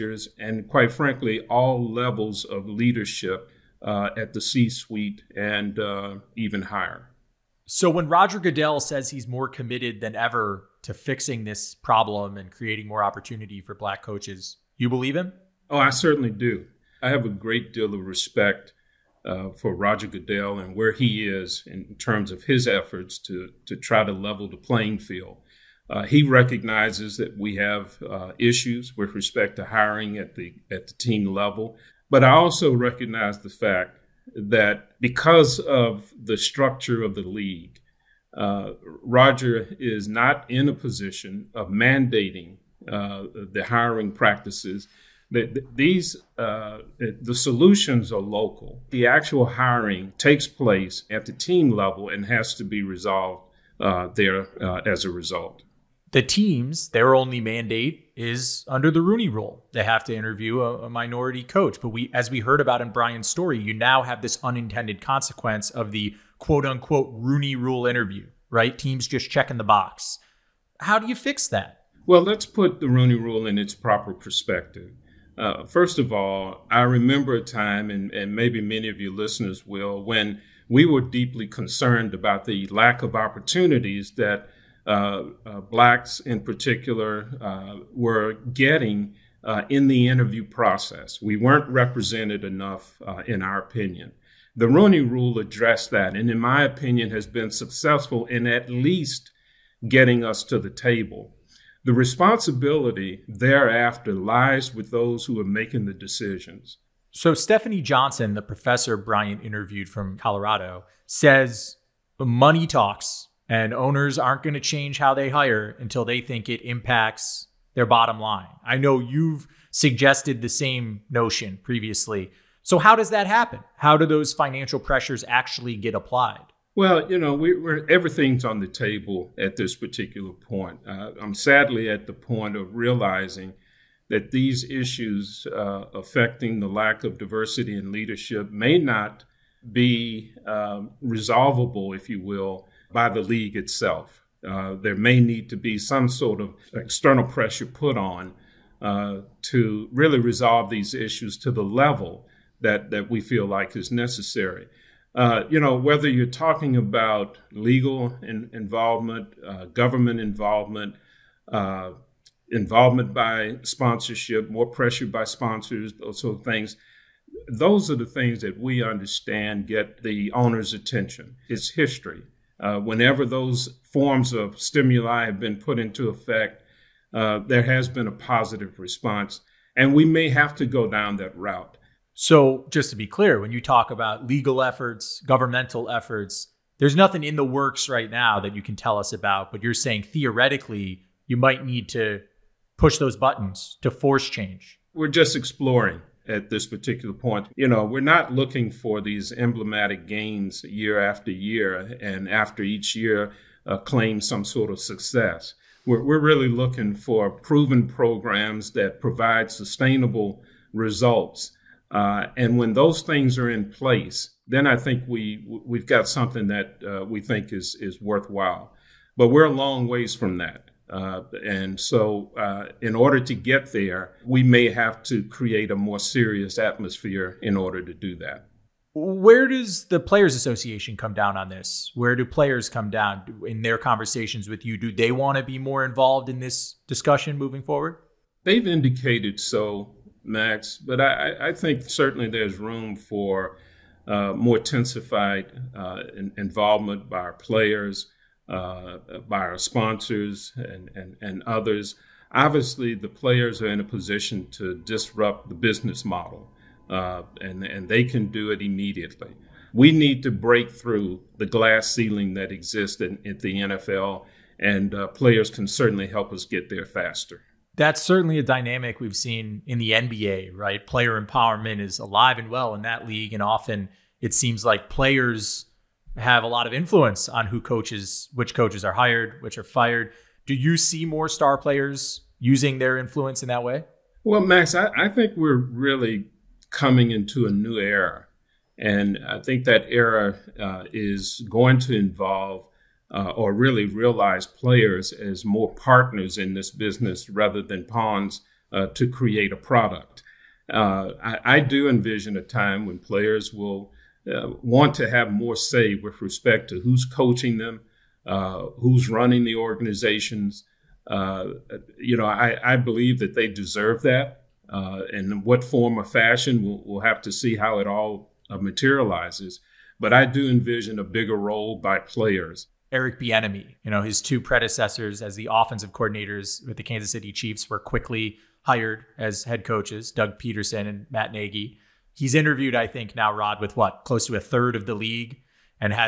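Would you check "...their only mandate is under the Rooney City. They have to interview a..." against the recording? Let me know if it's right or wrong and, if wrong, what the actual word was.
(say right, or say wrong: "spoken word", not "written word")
wrong: "Rule", not "City".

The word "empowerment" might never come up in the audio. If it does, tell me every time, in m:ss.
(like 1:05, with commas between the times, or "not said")
4:31.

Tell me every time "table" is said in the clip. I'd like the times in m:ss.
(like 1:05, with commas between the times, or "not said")
1:40, 2:08.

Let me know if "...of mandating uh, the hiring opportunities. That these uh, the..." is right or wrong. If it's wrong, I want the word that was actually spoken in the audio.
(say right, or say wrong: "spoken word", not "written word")
wrong: "practices", not "opportunities".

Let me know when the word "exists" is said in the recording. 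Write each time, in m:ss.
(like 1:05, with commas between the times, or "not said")
4:22.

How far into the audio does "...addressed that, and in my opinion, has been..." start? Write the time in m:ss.
1:35.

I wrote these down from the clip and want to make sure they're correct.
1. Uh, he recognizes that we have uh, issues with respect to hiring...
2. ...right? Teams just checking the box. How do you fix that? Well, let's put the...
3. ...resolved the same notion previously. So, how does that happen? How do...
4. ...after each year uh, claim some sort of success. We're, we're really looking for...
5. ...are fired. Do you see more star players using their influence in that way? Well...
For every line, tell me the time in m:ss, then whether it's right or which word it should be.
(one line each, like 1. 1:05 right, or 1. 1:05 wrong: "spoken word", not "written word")
1. 0:25 right
2. 1:08 right
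3. 1:59 wrong: "suggested", not "resolved"
4. 3:22 right
5. 4:39 right.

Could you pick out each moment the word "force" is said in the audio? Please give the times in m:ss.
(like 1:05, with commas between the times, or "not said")
3:13.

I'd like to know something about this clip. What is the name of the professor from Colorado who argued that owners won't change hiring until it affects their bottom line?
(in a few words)
Stephanie Johnson.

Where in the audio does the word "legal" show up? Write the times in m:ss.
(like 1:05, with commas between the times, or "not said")
2:37, 3:04.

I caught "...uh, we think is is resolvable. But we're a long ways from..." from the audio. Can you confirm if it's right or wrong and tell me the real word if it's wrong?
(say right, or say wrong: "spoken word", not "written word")
wrong: "worthwhile", not "resolvable".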